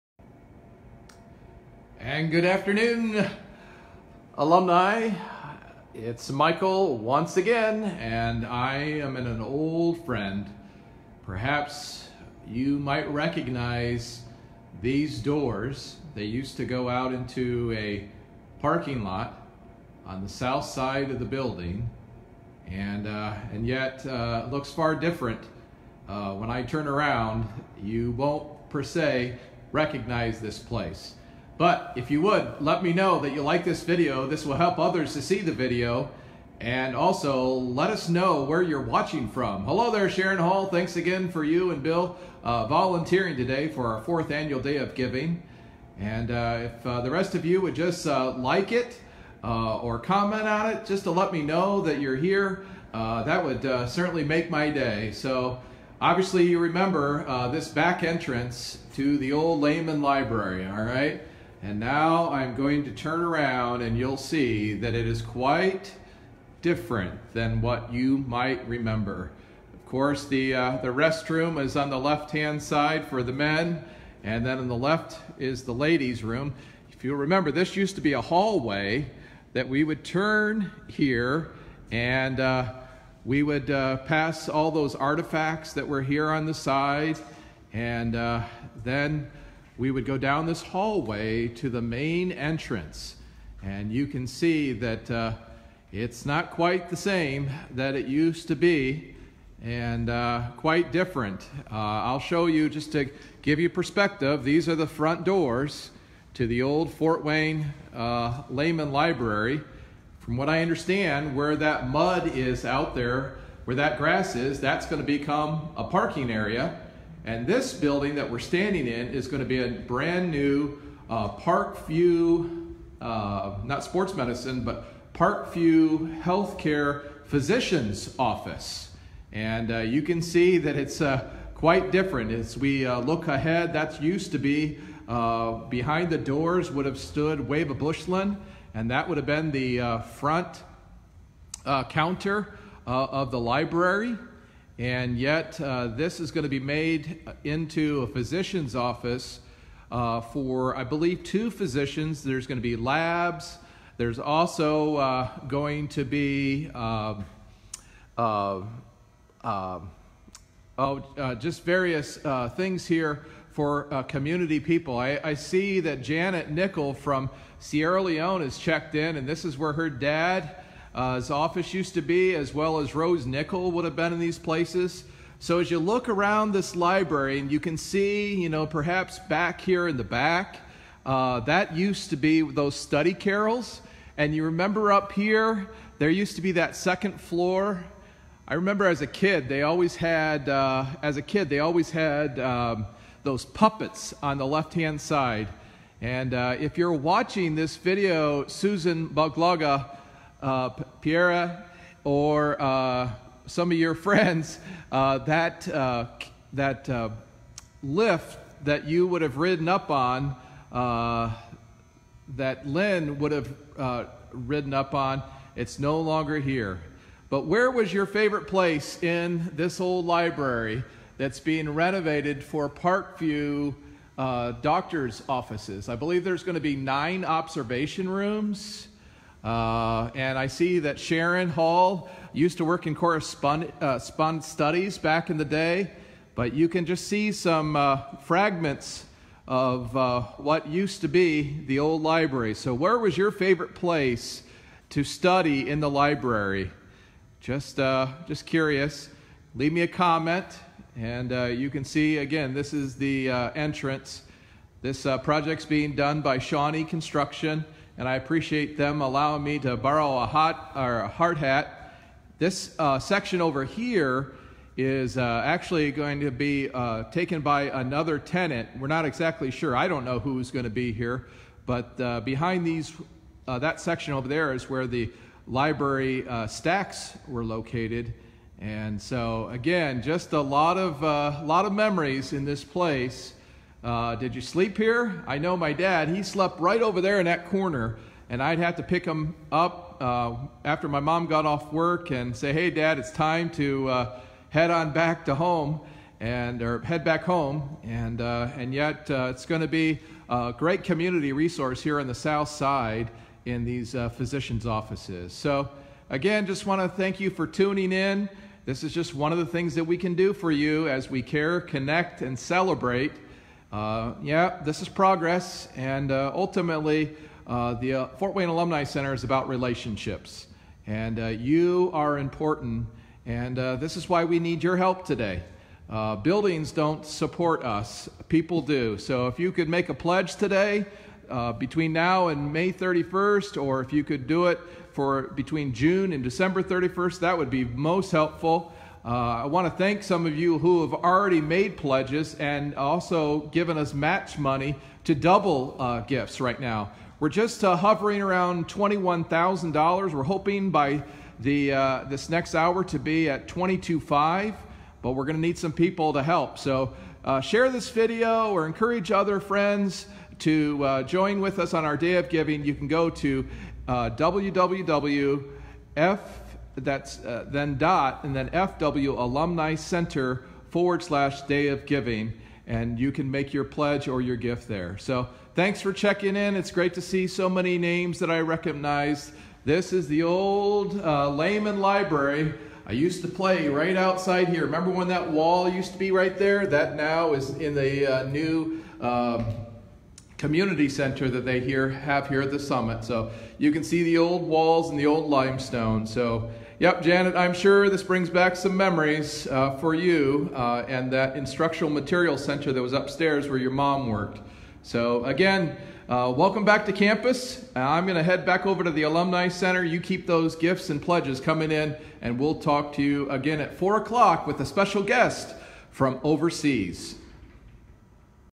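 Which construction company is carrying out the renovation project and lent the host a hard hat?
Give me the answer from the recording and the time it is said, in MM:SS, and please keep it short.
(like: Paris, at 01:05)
Shawnee Construction, at 04:16.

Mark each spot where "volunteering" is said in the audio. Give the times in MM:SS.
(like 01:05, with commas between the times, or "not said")
00:42.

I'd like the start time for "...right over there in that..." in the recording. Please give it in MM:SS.
04:46.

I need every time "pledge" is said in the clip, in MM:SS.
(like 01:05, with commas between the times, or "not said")
05:29, 05:41, 06:13, 06:50.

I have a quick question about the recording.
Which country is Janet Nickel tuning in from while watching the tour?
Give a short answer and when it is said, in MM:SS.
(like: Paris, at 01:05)
Sierra Leone, at 02:47.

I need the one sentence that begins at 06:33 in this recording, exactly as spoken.
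So you can see the old walls and the old limestone.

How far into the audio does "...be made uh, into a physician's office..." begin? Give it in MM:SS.
02:26.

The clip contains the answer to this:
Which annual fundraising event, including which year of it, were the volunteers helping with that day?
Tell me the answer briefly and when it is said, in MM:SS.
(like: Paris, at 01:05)
Fourth annual Day of Giving, at 00:44.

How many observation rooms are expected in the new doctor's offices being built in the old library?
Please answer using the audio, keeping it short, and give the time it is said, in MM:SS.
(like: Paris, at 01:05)
9, at 03:46.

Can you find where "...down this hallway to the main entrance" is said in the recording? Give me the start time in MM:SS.
01:30.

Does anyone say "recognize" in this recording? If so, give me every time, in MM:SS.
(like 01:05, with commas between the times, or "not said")
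00:13, 00:29, 06:18.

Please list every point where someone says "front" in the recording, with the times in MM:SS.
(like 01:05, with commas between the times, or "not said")
01:44, 02:20.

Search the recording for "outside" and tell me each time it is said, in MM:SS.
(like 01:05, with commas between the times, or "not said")
06:23.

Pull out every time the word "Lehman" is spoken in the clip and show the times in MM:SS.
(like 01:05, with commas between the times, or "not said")
00:59, 01:48, 06:21.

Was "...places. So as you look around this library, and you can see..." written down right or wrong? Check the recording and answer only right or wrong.
right.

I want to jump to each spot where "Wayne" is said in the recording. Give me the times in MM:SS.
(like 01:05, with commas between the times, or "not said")
01:47, 05:18.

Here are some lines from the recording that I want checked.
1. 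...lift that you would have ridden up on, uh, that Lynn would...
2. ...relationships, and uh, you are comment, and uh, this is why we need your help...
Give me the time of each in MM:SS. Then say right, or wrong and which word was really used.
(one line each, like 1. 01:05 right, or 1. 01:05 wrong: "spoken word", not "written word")
1. 03:27 right
2. 05:19 wrong: "important", not "comment".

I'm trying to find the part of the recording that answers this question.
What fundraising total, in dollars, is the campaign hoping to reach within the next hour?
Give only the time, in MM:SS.
05:53.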